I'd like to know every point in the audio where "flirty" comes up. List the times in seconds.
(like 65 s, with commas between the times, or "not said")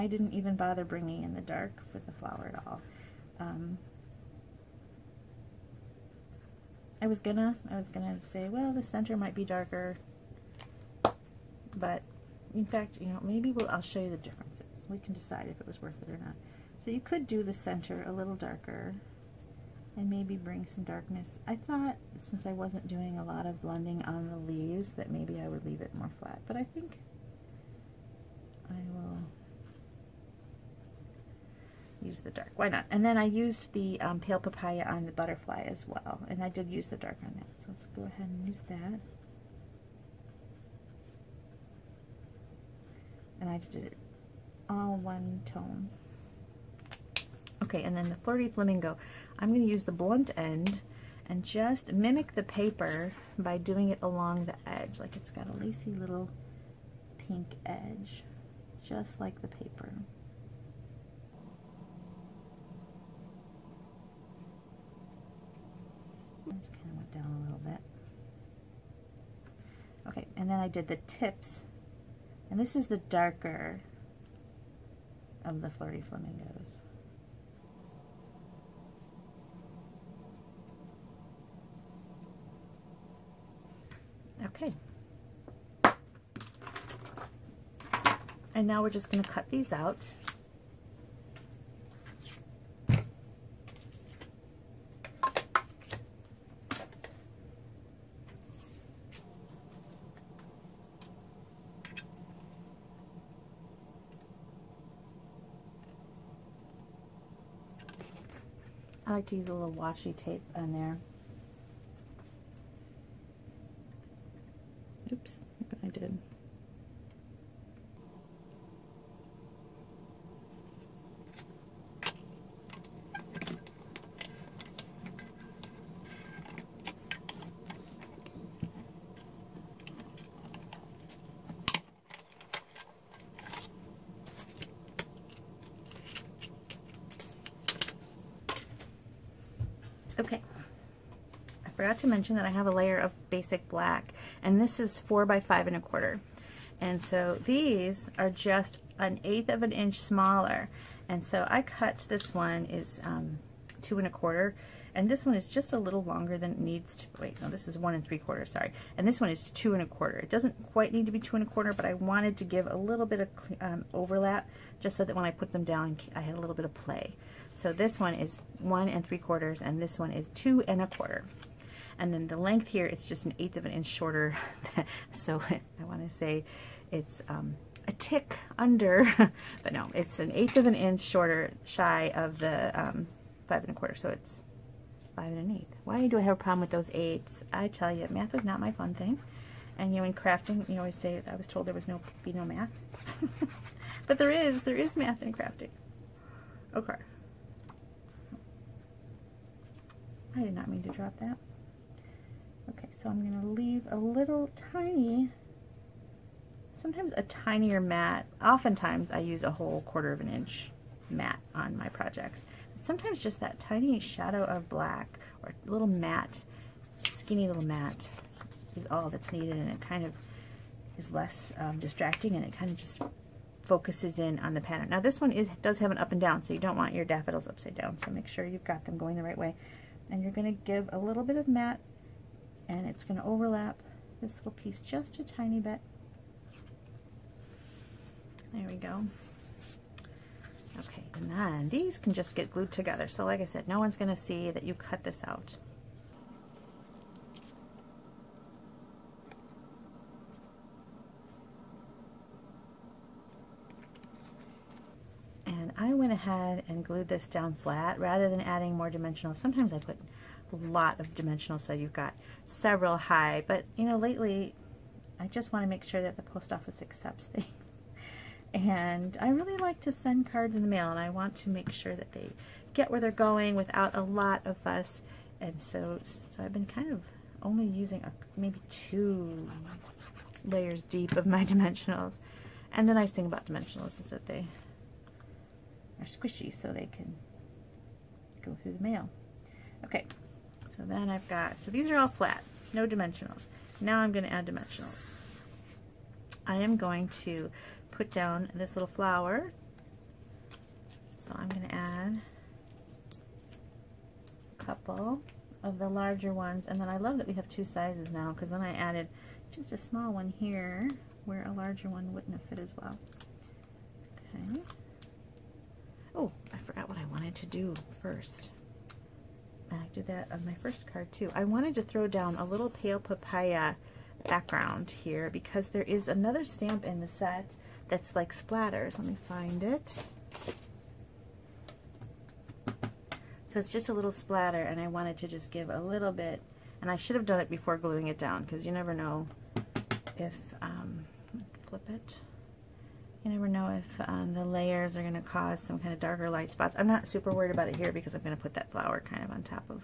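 48 s, 75 s.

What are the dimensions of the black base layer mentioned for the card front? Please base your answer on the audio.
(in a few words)
4 by 5 1/4.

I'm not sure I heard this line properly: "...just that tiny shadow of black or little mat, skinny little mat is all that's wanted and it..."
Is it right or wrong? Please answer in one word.
wrong.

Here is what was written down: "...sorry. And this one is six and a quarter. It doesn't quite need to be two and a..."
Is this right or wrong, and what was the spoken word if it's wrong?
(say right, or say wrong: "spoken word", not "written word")
wrong: "two", not "six".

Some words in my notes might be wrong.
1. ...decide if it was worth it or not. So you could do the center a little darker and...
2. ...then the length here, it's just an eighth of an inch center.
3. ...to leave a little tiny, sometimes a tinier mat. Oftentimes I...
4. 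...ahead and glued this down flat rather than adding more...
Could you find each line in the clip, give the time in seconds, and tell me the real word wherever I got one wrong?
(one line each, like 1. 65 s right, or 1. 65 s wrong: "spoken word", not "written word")
1. 15 s right
2. 172 s wrong: "shorter", not "center"
3. 203 s right
4. 256 s right.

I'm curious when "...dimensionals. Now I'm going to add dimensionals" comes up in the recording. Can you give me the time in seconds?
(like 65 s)
292 s.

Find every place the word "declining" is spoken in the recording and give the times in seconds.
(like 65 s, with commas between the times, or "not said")
not said.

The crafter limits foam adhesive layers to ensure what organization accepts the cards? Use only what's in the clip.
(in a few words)
Post office.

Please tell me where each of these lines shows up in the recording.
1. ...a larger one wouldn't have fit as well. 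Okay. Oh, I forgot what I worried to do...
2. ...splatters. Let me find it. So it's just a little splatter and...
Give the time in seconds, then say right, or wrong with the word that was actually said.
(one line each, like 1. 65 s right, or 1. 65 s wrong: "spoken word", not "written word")
1. 311 s wrong: "wanted", not "worried"
2. 328 s right.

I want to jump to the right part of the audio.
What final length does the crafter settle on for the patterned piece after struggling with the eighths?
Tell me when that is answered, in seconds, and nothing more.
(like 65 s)
185 s.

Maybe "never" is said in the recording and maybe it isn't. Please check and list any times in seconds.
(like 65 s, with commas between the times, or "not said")
338 s, 343 s.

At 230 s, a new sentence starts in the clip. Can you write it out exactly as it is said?
And you're going to give a little bit of mat and it's going to overlap this little piece just a tiny bit.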